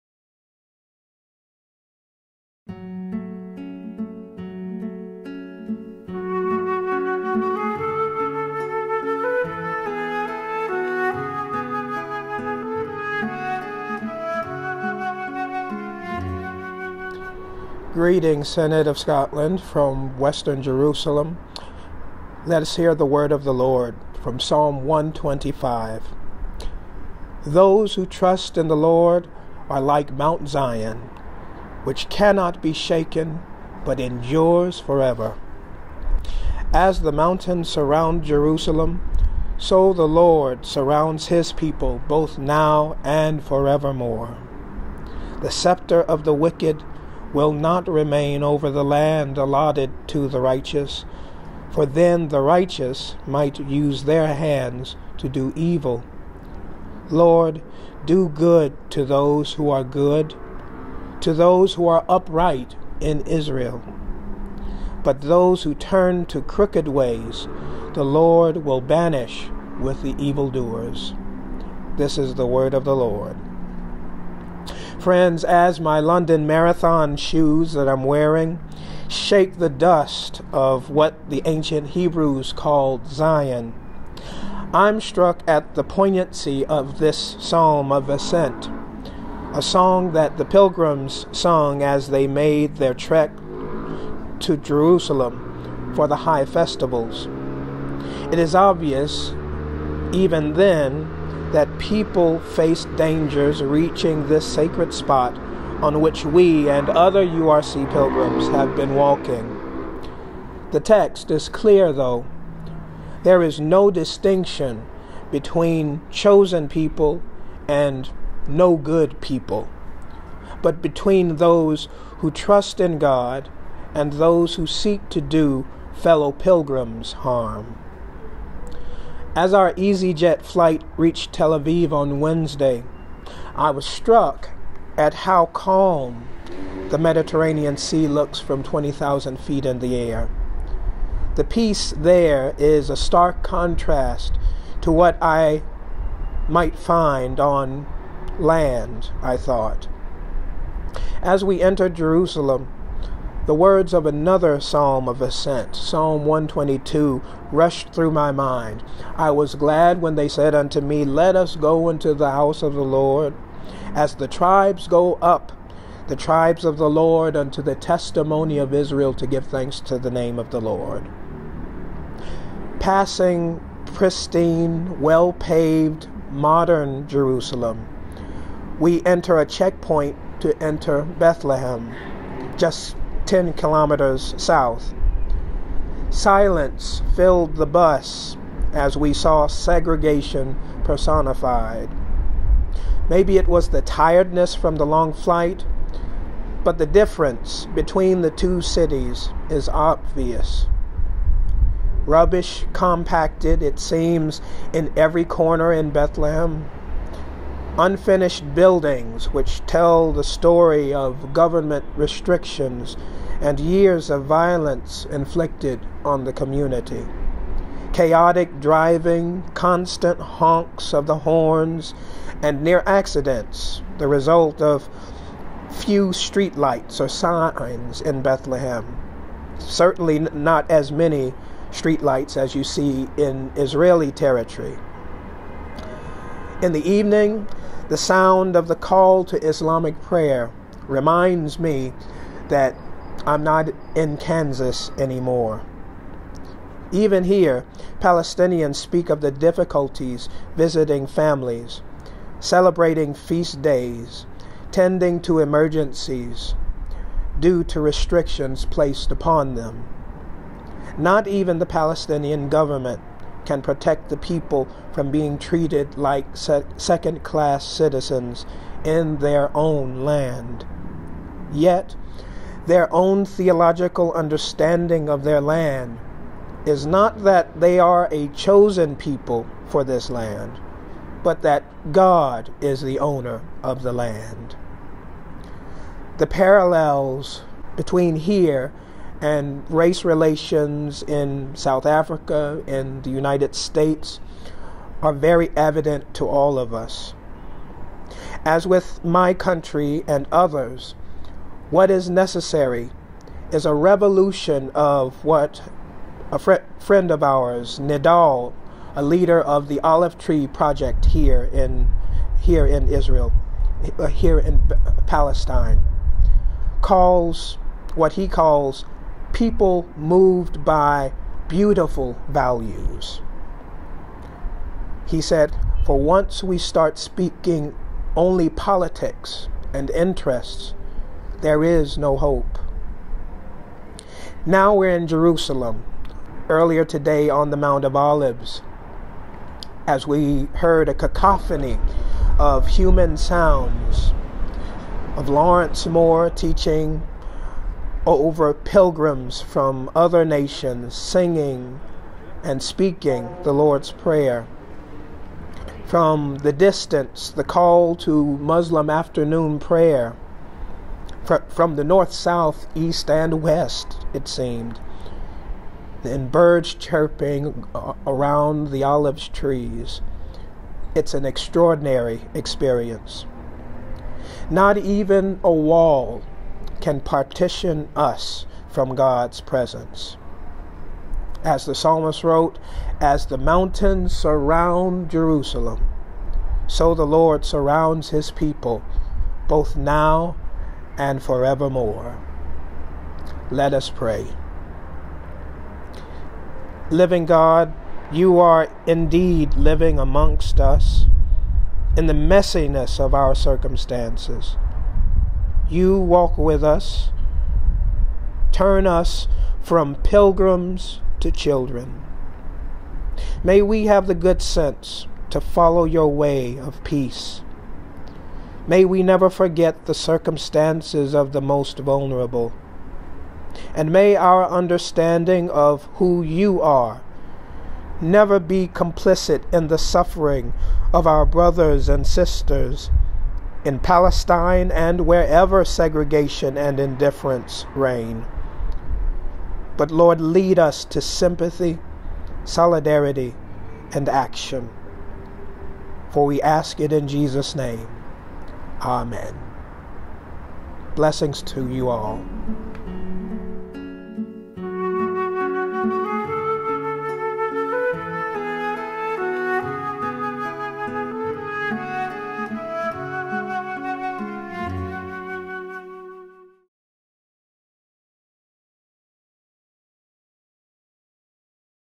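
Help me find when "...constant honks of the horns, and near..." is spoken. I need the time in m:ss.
3:39.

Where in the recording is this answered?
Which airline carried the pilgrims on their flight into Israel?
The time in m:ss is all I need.
2:09.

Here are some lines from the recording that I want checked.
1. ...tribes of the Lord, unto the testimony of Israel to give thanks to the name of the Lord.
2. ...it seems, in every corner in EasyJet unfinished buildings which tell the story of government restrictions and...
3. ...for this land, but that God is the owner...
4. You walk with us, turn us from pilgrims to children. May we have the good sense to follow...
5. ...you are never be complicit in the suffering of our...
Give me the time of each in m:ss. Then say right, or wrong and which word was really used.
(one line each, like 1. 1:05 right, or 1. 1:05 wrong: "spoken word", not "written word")
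1. 2:46 right
2. 3:23 wrong: "Bethlehem", not "EasyJet"
3. 4:39 right
4. 6:45 right
5. 7:06 right.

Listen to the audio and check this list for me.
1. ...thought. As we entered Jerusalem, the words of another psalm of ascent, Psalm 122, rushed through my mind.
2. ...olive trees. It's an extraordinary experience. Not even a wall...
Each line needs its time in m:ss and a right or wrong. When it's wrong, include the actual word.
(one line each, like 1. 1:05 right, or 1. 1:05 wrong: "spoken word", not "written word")
1. 2:29 right
2. 6:08 right.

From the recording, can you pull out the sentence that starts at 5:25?
He said, For once we start speaking only politics and interests, there is no hope.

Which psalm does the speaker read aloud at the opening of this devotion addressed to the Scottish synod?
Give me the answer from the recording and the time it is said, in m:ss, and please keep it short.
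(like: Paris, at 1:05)
Psalm 125, at 0:24.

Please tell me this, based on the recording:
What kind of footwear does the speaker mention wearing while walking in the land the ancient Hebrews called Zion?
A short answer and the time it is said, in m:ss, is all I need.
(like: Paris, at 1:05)
London Marathon shoes, at 1:15.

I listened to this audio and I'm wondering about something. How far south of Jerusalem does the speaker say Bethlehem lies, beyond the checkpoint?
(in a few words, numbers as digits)
10 kilometers.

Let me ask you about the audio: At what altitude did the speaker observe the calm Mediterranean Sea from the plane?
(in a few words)
20,000 feet.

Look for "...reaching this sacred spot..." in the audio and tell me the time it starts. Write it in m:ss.
1:43.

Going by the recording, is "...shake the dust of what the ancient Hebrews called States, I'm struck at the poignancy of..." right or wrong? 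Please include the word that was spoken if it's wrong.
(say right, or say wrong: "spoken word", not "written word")
wrong: "Zion", not "States".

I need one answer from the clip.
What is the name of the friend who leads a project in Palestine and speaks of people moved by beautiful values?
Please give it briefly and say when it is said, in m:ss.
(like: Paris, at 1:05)
Nidal, at 5:07.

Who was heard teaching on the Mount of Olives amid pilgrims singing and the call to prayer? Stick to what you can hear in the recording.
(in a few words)
Lawrence Moore.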